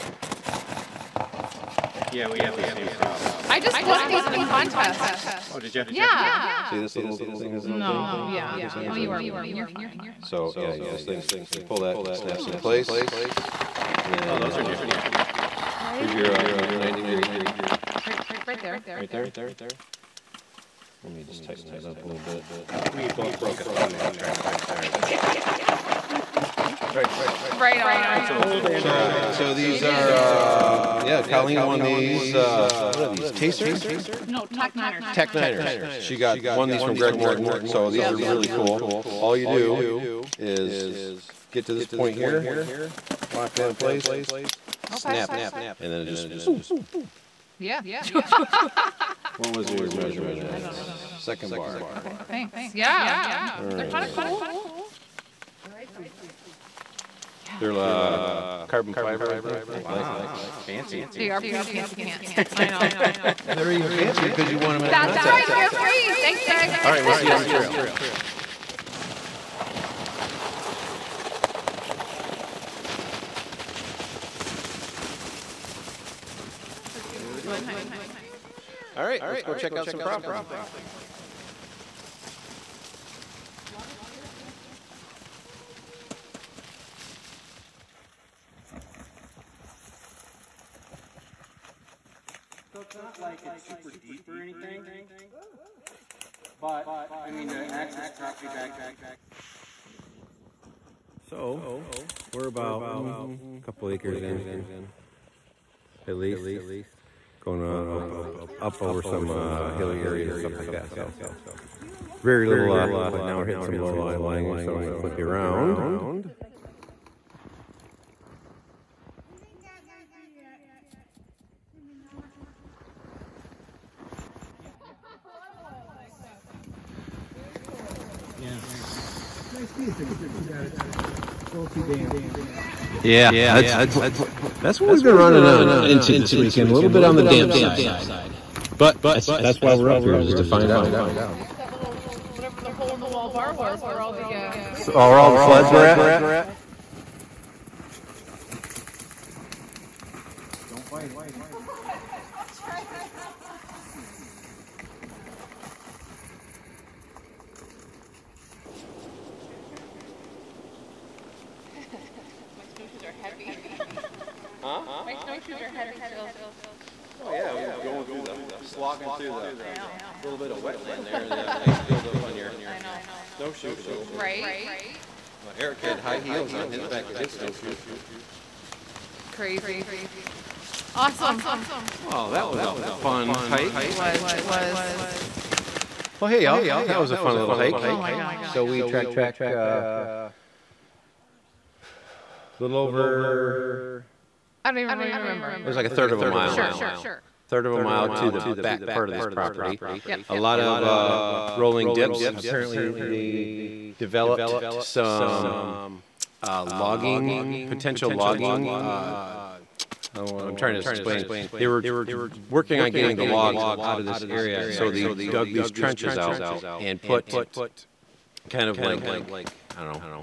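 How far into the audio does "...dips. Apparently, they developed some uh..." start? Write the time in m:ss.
3:21.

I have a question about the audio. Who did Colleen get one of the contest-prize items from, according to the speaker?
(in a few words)
Greg Morton.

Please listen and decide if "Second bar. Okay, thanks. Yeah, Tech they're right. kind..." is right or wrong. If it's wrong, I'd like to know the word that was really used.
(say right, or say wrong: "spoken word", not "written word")
wrong: "All", not "Tech".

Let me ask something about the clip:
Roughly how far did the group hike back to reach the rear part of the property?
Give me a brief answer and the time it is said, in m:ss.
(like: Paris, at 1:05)
a third of a mile, at 3:15.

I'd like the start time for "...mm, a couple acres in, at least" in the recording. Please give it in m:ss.
1:42.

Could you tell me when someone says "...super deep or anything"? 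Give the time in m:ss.
1:33.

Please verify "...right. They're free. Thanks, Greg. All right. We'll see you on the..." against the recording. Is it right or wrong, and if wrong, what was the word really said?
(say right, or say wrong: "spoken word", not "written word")
right.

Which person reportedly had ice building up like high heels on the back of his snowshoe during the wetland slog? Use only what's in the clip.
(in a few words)
Eric.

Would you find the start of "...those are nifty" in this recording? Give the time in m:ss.
0:14.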